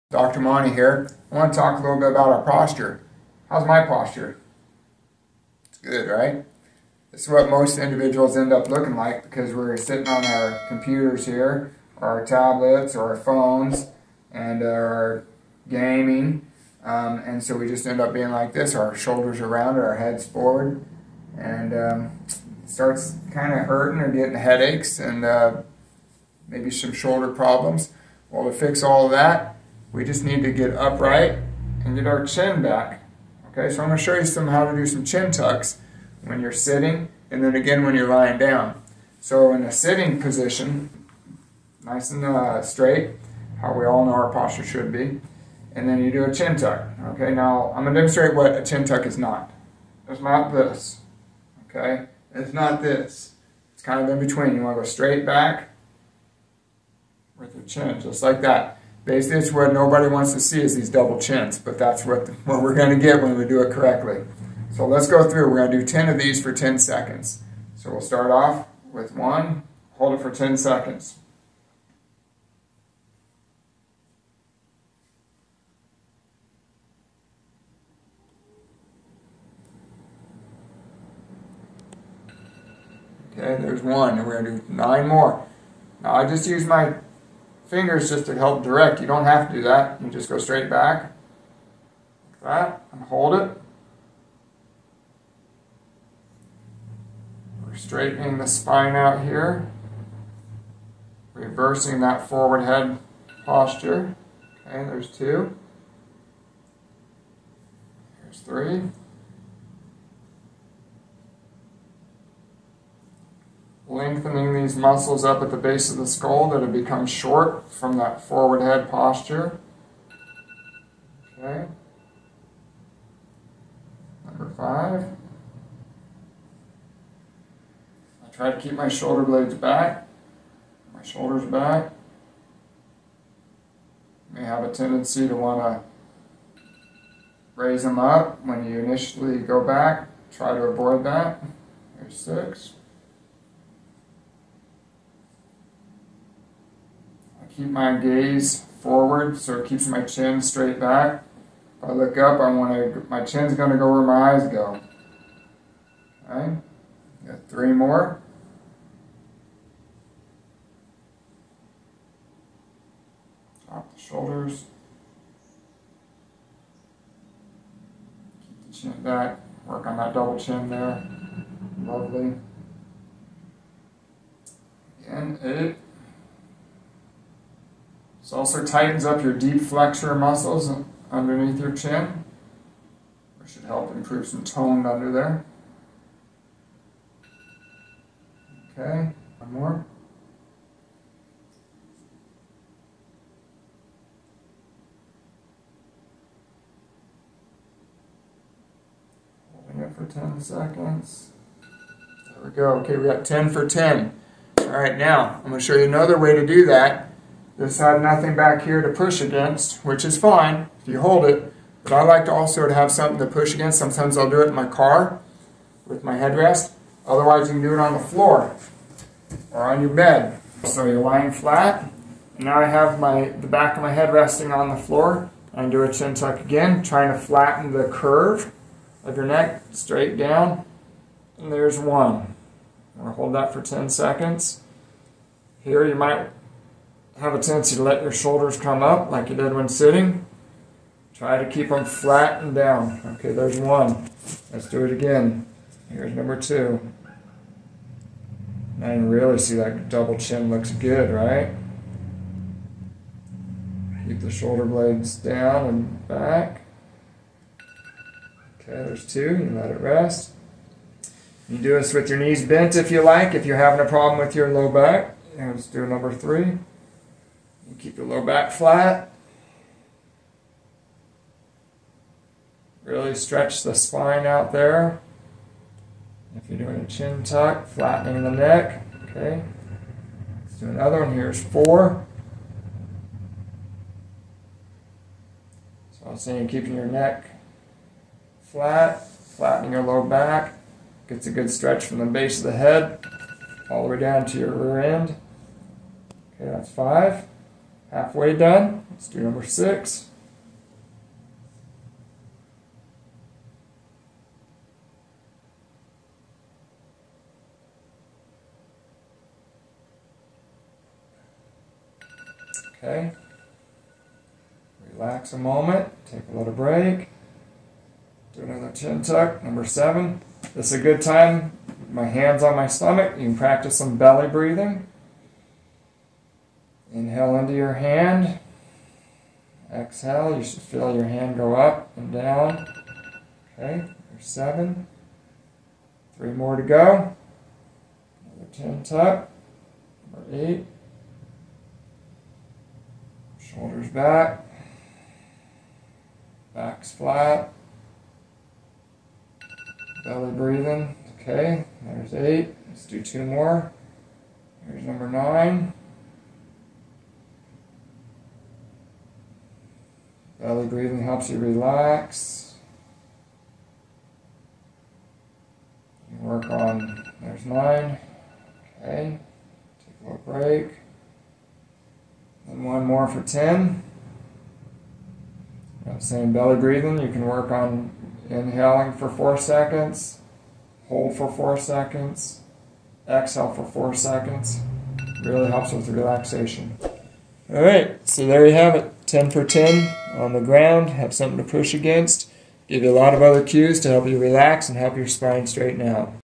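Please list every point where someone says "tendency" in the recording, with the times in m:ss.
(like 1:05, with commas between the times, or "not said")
2:14, 3:57.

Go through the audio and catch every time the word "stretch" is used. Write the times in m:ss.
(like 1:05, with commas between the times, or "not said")
4:33, 4:51.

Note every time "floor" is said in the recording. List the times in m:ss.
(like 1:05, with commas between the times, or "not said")
3:37, 3:44.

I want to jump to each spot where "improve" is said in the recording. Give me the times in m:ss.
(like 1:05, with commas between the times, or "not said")
3:03.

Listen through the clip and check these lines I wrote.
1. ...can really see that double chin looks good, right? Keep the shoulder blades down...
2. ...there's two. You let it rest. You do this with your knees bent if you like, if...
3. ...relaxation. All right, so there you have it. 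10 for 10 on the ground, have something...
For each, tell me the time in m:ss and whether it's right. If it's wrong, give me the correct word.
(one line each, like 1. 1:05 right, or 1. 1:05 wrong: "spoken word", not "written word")
1. 4:08 right
2. 4:18 right
3. 6:25 right.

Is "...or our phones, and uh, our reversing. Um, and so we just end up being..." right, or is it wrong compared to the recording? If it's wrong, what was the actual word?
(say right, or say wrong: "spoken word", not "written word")
wrong: "gaming", not "reversing".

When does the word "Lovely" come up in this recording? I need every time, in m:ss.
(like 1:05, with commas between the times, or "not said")
2:51.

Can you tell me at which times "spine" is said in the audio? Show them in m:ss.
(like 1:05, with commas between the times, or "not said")
1:38, 4:33, 6:35.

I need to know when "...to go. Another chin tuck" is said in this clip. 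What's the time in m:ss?
5:36.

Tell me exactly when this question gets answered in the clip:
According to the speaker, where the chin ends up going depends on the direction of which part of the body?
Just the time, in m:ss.
2:34.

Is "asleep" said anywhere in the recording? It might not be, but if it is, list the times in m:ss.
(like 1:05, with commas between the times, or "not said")
not said.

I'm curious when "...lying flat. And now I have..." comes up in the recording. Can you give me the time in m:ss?
3:41.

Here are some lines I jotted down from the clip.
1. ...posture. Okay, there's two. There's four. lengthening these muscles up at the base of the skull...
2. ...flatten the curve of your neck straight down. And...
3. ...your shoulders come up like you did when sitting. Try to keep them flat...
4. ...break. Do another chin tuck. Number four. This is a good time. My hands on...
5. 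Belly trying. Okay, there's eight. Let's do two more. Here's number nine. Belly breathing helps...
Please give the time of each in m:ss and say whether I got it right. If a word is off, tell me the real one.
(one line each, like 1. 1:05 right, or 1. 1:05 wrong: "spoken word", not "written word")
1. 1:43 wrong: "three", not "four"
2. 3:47 right
3. 3:58 right
4. 5:16 wrong: "seven", not "four"
5. 5:50 wrong: "breathing", not "trying".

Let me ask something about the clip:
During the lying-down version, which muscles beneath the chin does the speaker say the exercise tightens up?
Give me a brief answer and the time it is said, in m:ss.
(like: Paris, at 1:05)
deep flexor muscles, at 2:59.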